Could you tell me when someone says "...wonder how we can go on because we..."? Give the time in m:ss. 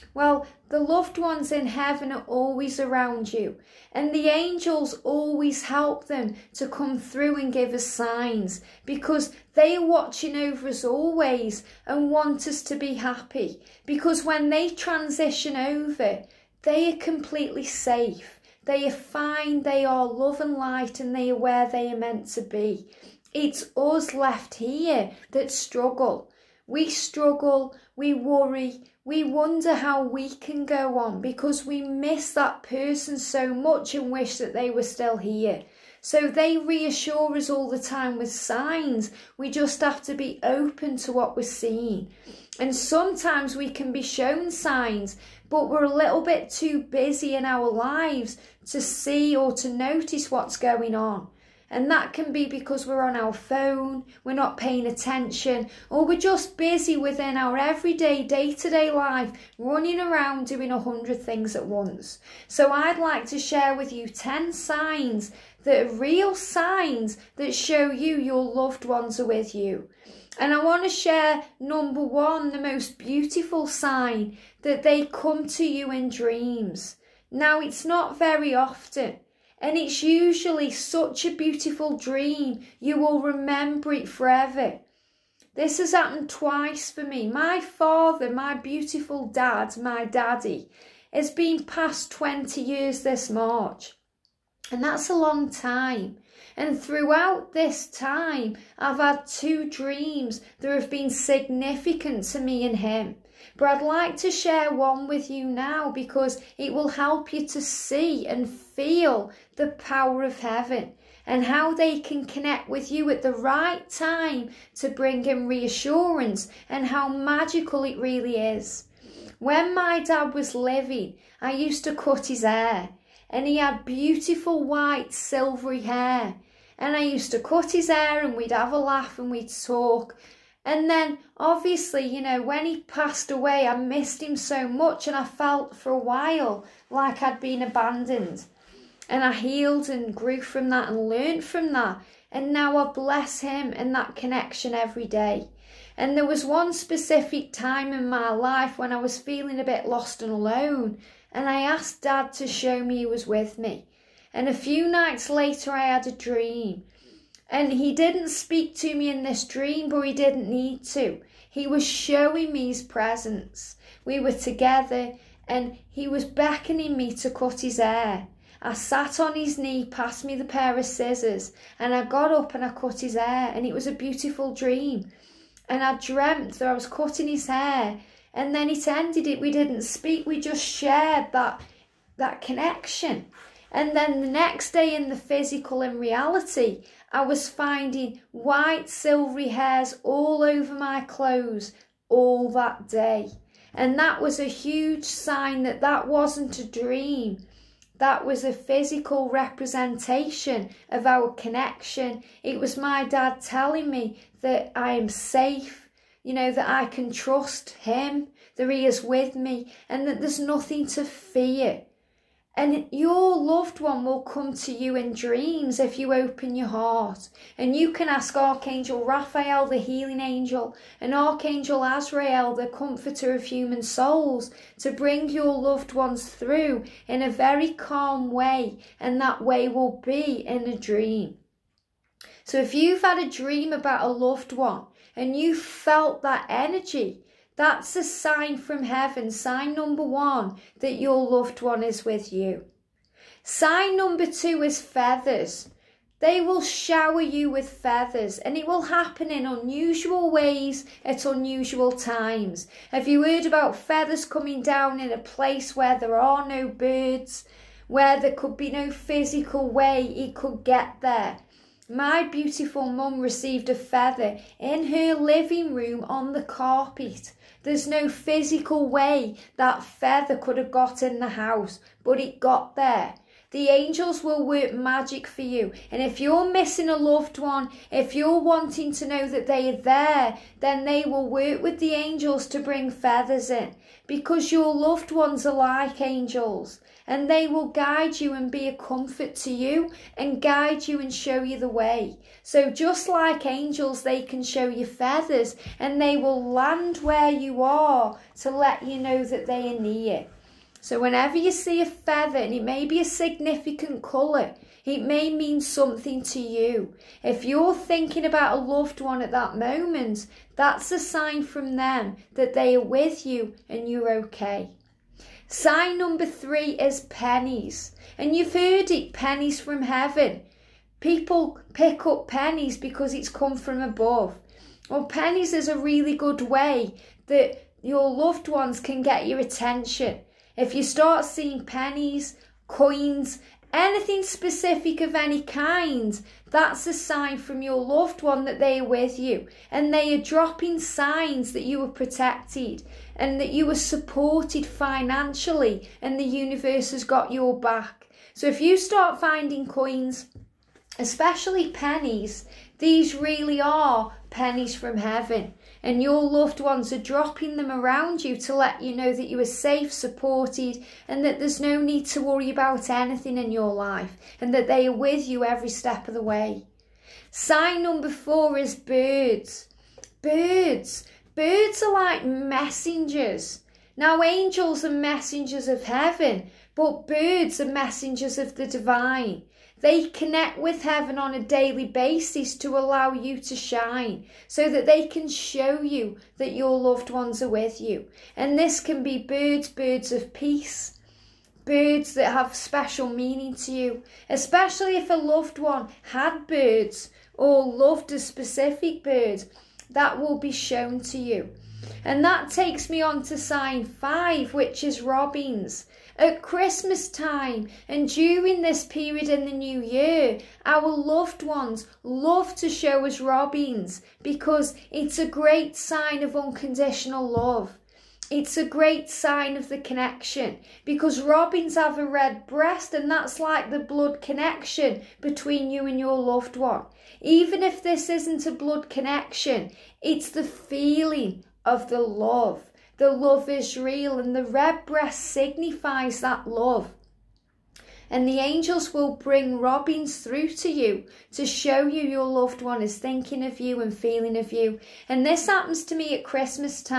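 0:29.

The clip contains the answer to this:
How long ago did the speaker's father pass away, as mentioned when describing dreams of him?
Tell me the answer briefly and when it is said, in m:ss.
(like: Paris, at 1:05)
20 years, at 1:32.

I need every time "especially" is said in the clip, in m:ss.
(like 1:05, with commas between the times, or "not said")
5:50, 6:34.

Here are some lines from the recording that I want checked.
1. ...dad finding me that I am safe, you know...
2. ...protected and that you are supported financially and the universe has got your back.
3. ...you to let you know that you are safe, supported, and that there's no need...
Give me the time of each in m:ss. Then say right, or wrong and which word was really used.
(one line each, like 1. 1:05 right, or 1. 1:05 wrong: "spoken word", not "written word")
1. 3:23 wrong: "telling", not "finding"
2. 5:41 right
3. 5:58 right.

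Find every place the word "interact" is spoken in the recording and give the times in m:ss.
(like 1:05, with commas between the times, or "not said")
not said.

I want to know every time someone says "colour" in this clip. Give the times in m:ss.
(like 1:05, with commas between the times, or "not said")
5:03.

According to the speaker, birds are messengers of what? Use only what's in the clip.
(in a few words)
The divine.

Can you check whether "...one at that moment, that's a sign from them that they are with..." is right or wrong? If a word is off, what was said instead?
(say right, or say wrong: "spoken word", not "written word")
right.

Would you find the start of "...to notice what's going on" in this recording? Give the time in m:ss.
0:49.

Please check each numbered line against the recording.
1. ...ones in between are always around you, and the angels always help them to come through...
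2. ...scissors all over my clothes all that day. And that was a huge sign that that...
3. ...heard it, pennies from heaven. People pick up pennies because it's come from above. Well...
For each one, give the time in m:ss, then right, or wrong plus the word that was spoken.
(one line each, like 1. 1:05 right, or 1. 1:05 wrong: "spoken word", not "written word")
1. 0:01 wrong: "heaven", not "between"
2. 3:09 wrong: "hairs", not "scissors"
3. 5:18 right.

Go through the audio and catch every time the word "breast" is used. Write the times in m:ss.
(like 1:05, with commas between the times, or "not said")
7:02, 7:14.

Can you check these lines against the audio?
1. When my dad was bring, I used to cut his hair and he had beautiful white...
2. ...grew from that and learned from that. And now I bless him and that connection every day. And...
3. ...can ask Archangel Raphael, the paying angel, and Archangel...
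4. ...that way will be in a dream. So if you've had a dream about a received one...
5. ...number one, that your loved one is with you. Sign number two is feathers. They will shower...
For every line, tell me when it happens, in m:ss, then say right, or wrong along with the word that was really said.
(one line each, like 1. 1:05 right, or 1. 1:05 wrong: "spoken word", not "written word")
1. 1:59 wrong: "living", not "bring"
2. 2:20 right
3. 3:37 wrong: "healing", not "paying"
4. 3:49 wrong: "loved", not "received"
5. 3:59 right.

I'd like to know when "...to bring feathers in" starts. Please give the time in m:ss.
4:42.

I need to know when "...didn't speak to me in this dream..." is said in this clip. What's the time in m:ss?
2:37.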